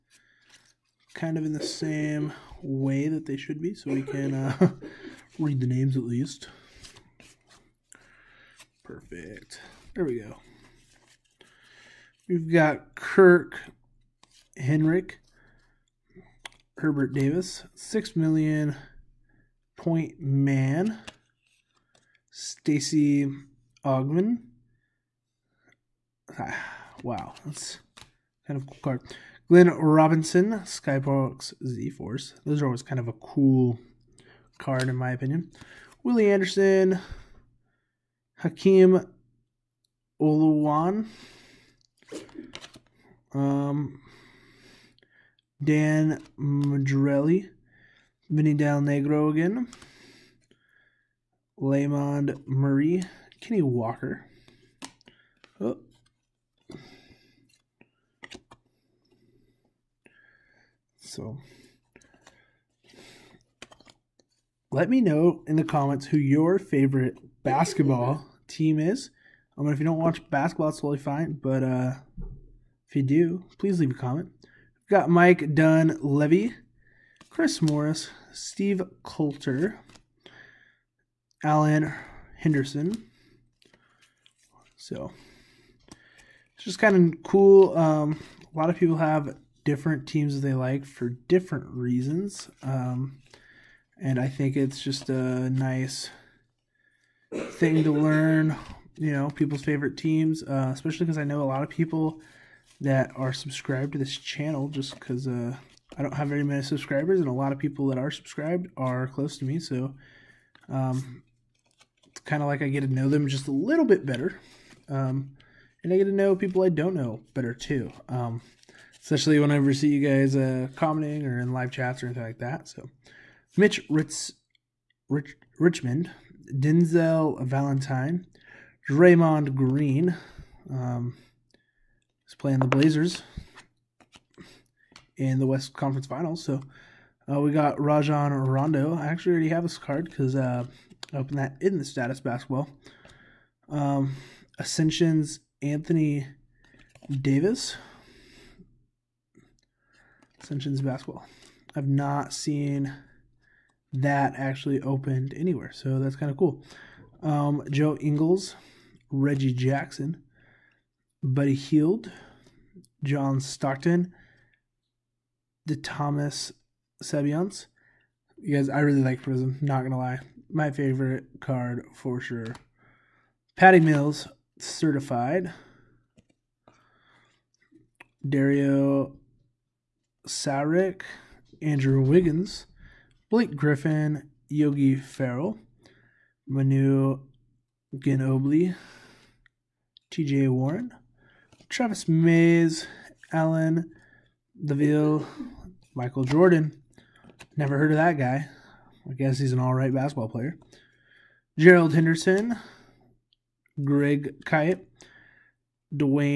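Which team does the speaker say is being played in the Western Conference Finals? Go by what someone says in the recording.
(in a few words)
the Blazers.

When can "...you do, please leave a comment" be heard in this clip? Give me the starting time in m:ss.
1:12.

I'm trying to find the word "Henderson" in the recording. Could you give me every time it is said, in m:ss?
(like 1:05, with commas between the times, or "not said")
1:22, 3:21.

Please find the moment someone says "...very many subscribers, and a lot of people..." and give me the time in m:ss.
1:46.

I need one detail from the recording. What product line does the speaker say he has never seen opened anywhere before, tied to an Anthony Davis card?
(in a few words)
Ascension's basketball.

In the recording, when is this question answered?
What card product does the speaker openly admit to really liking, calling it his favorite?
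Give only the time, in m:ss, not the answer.
2:49.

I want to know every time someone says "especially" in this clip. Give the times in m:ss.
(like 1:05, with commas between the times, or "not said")
1:40, 1:59.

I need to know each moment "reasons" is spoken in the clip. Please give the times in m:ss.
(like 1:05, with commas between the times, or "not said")
1:31.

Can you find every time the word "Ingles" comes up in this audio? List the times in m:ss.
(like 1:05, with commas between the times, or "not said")
2:37.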